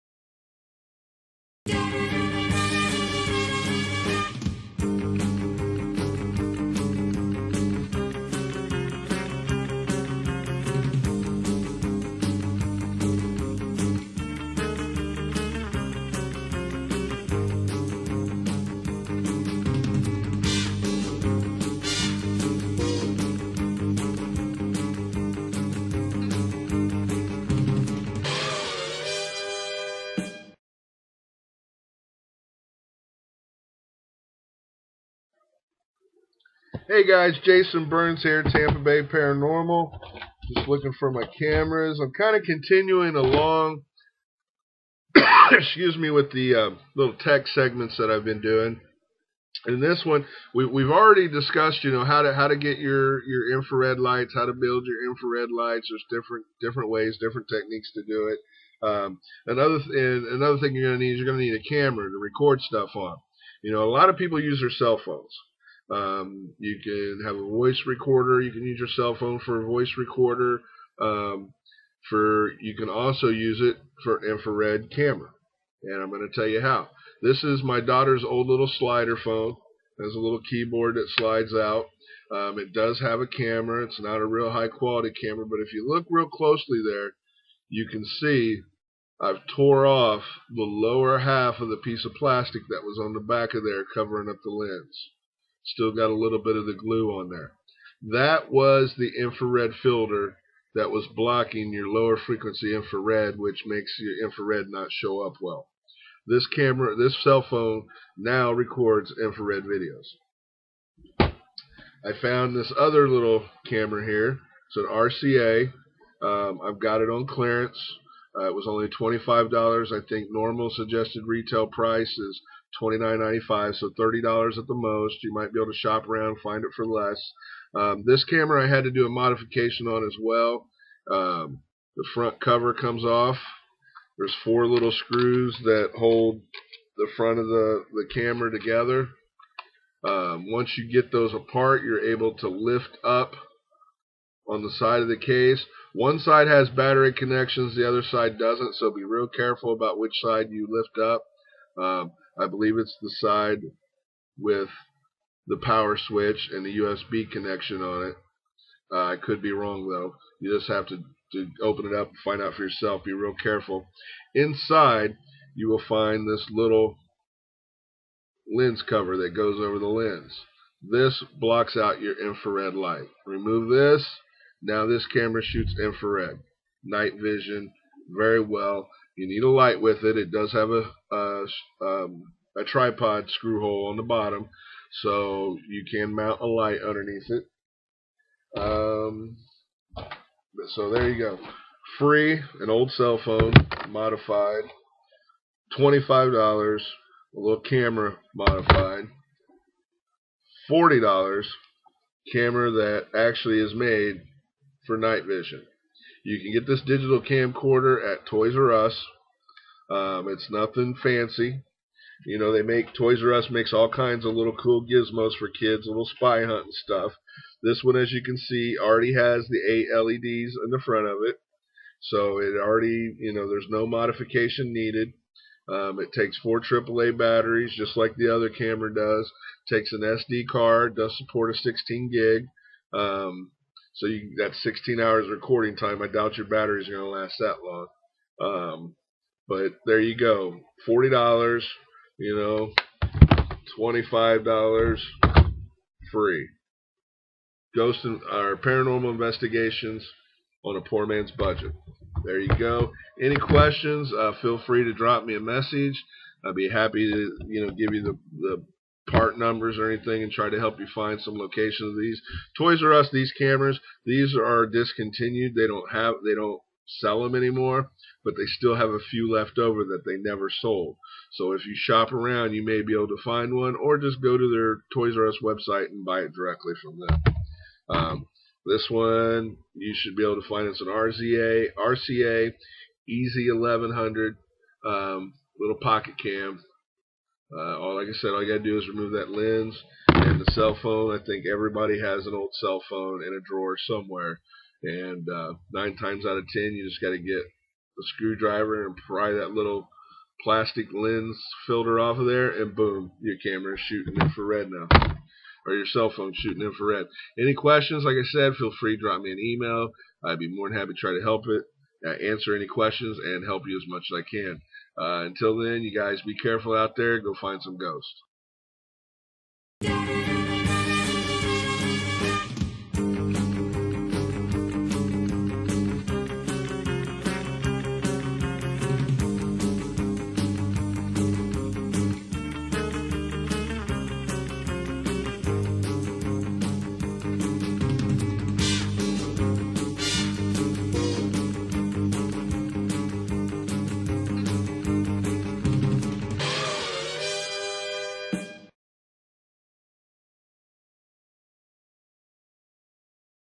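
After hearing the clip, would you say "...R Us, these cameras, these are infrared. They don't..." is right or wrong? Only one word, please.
wrong.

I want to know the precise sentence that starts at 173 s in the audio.
Remove this now this camera shoots infrared, night vision, very well.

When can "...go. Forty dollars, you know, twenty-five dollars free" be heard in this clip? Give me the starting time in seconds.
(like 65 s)
240 s.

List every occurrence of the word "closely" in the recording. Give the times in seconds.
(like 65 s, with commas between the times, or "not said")
86 s.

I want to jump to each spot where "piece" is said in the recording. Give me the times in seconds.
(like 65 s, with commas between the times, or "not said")
91 s.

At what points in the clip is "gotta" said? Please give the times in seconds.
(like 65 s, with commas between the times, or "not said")
288 s, 297 s.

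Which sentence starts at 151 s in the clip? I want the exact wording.
Um, I believe it's the side with the power switch and the USB connection on it.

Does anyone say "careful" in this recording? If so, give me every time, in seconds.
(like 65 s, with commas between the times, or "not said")
149 s, 163 s, 316 s.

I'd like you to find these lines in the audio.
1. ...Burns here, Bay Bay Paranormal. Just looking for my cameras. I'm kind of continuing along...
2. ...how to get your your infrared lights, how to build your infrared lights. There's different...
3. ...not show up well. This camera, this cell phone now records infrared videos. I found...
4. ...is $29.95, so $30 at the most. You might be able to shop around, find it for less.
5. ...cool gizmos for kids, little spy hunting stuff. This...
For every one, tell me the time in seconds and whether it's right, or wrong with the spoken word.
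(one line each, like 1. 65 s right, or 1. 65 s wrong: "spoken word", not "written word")
1. 37 s wrong: "Tampa", not "Bay"
2. 52 s right
3. 104 s right
4. 122 s right
5. 214 s right.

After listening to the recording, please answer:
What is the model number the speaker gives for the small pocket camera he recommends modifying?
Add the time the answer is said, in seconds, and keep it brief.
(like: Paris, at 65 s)
EZ1100, at 283 s.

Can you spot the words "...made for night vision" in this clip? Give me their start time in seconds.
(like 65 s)
203 s.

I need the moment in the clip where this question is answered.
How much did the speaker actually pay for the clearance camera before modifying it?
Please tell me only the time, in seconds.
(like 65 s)
118 s.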